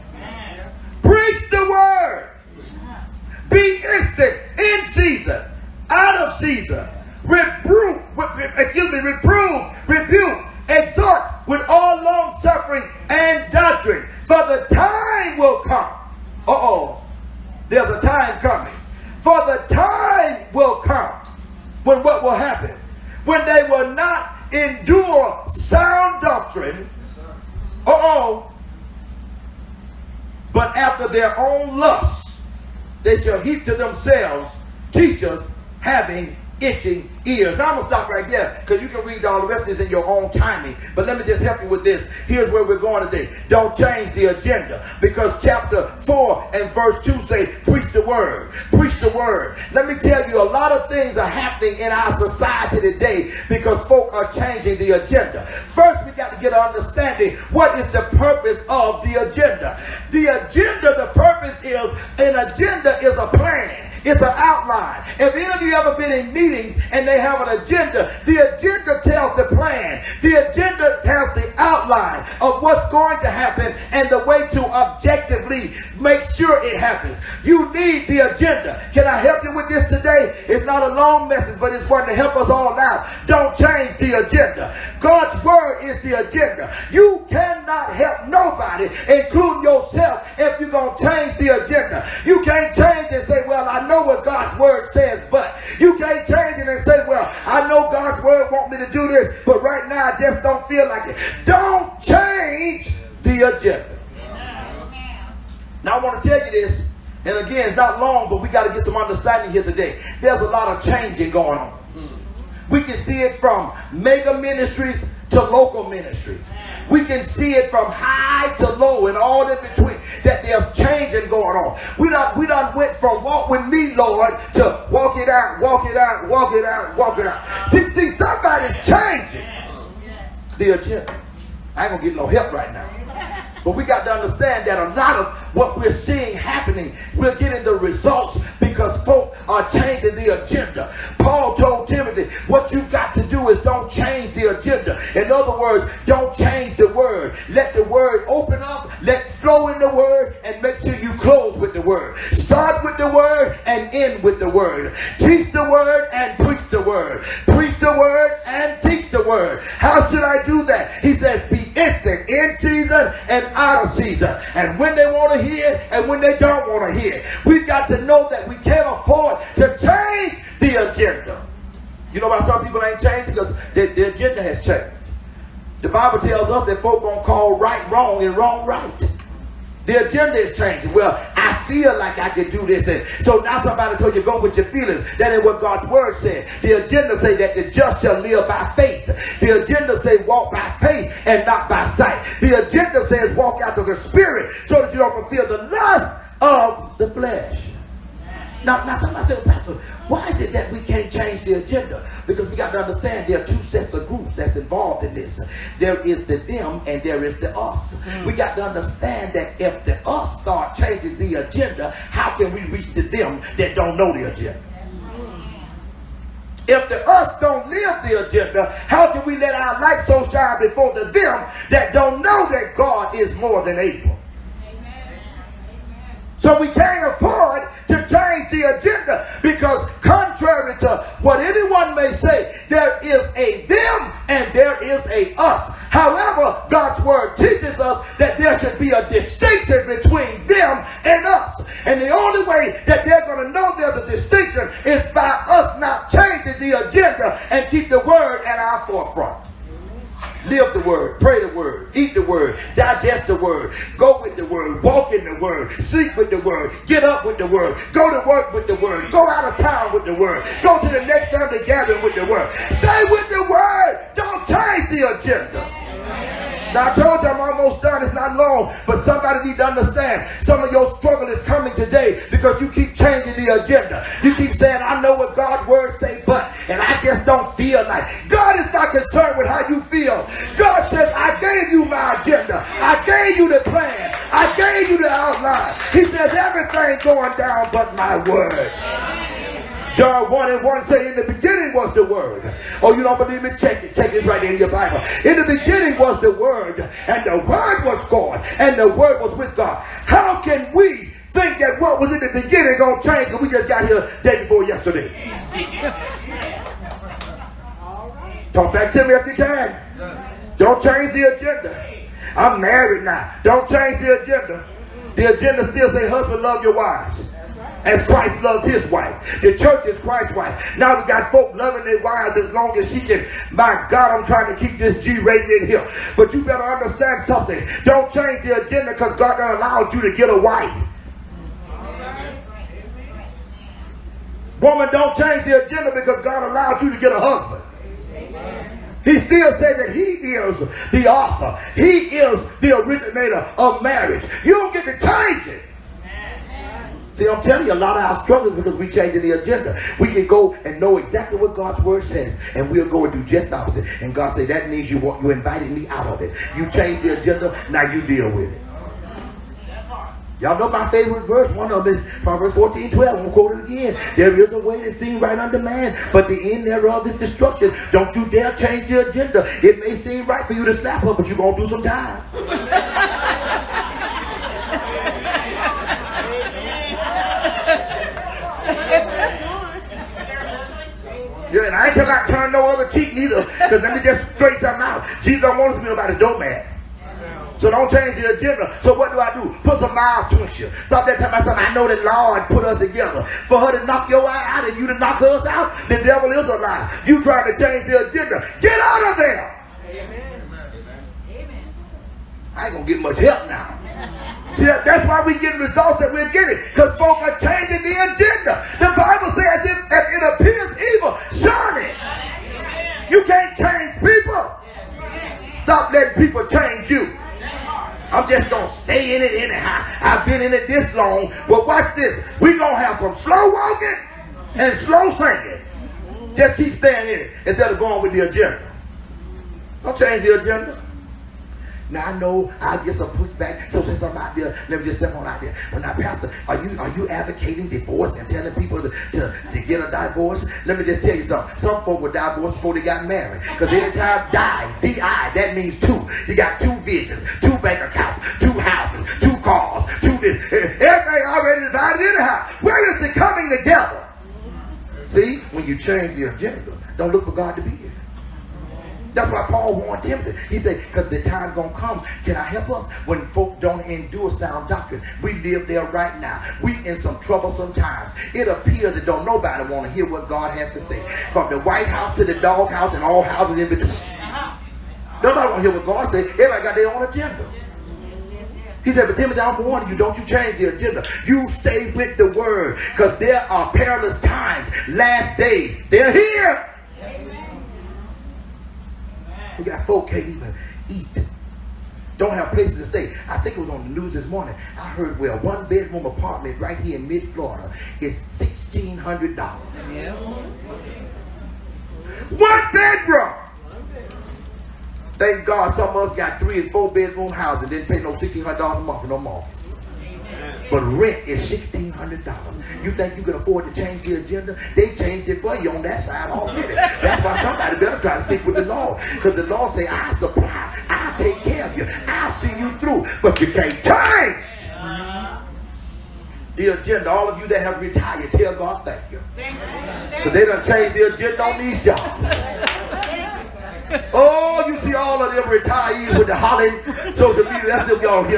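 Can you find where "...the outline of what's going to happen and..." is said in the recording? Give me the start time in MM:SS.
01:11.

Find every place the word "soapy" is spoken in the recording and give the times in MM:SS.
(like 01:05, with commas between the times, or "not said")
not said.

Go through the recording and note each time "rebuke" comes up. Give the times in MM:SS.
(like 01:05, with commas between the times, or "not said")
00:09.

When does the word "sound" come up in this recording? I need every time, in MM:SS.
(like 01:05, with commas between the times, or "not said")
00:25, 07:44.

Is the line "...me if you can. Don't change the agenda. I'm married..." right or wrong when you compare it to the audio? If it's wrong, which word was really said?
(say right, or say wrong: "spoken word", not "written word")
right.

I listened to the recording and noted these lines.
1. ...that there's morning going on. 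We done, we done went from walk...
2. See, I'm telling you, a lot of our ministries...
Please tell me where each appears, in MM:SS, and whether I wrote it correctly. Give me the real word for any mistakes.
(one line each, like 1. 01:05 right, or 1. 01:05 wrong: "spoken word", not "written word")
1. 02:00 wrong: "changing", not "morning"
2. 05:47 wrong: "struggles", not "ministries".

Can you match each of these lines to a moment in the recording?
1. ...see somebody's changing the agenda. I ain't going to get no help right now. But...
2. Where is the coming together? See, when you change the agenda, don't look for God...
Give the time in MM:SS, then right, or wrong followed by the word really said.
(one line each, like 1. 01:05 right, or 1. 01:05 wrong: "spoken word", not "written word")
1. 02:07 right
2. 07:32 right.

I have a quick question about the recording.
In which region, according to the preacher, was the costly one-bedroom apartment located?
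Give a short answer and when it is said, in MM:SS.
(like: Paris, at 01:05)
mid Florida, at 08:17.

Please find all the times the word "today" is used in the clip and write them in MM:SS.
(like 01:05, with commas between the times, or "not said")
00:43, 00:52, 01:19, 01:49, 04:31.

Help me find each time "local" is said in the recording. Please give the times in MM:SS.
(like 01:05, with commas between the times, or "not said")
01:55.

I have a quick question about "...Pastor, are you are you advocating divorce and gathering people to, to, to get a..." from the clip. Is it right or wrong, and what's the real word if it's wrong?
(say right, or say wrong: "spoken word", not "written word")
wrong: "telling", not "gathering".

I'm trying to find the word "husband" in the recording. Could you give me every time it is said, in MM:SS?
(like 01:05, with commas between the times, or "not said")
05:16, 05:37.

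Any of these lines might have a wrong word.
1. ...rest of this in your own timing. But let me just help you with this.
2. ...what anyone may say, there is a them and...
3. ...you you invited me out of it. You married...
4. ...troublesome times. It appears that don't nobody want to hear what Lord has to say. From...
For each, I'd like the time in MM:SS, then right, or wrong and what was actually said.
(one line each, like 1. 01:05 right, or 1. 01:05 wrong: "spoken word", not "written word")
1. 00:39 right
2. 03:51 right
3. 05:54 wrong: "changed", not "married"
4. 07:47 wrong: "God", not "Lord".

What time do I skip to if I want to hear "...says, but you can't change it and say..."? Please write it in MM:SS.
01:34.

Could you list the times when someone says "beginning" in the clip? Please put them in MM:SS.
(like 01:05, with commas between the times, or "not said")
04:51, 04:55, 05:02.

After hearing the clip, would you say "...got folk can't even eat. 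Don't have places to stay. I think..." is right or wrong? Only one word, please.
right.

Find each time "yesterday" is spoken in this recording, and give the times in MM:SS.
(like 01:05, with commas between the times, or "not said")
05:04.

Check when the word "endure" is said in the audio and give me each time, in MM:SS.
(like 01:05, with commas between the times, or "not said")
00:24, 07:43.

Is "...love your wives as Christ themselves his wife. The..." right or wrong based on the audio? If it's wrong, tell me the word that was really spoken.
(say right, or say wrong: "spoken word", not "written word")
wrong: "loves", not "themselves".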